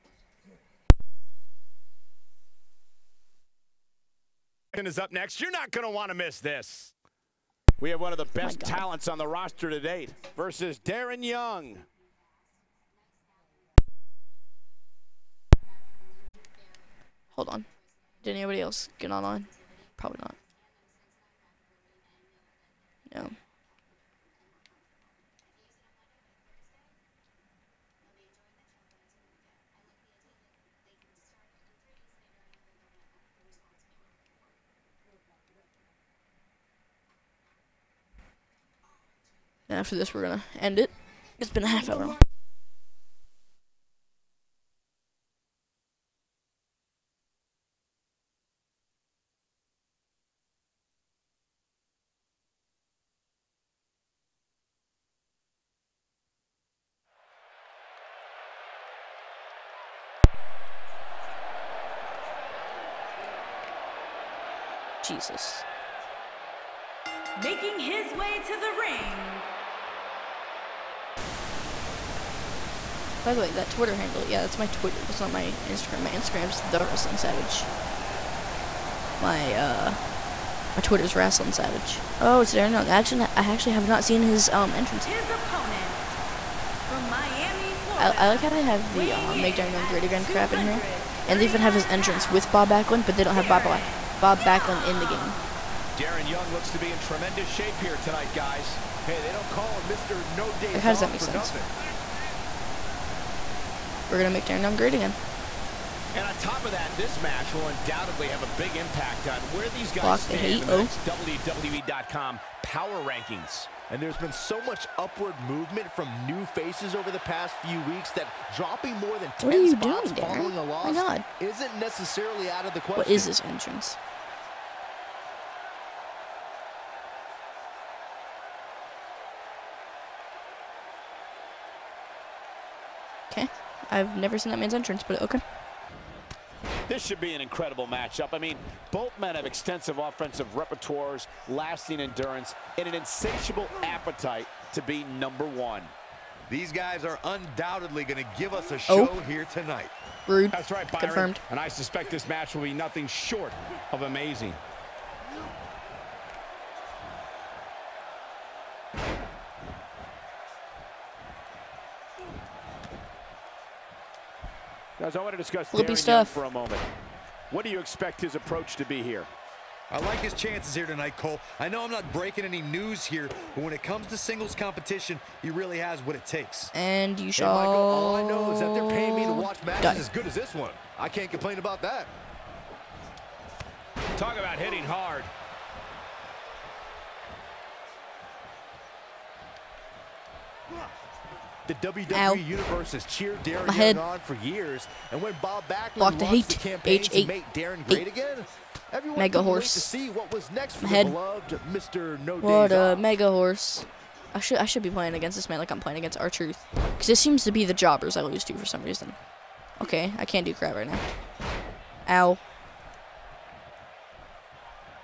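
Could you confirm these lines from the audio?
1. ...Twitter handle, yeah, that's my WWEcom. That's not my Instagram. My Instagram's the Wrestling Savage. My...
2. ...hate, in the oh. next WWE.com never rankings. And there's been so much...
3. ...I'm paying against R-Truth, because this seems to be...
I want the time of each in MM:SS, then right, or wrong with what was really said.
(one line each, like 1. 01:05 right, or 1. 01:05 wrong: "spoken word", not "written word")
1. 01:13 wrong: "Twitter", not "WWEcom"
2. 01:50 wrong: "power", not "never"
3. 03:25 wrong: "playing", not "paying".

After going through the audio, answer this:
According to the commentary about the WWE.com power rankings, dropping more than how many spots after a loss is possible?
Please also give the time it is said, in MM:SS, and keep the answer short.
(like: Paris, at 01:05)
10, at 01:59.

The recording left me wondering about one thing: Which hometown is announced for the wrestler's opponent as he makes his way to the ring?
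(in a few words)
Miami, Florida.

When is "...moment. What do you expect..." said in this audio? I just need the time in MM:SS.
02:46.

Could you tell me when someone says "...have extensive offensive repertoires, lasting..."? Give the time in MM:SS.
02:19.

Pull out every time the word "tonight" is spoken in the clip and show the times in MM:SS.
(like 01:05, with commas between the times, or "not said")
01:37, 02:29, 02:50.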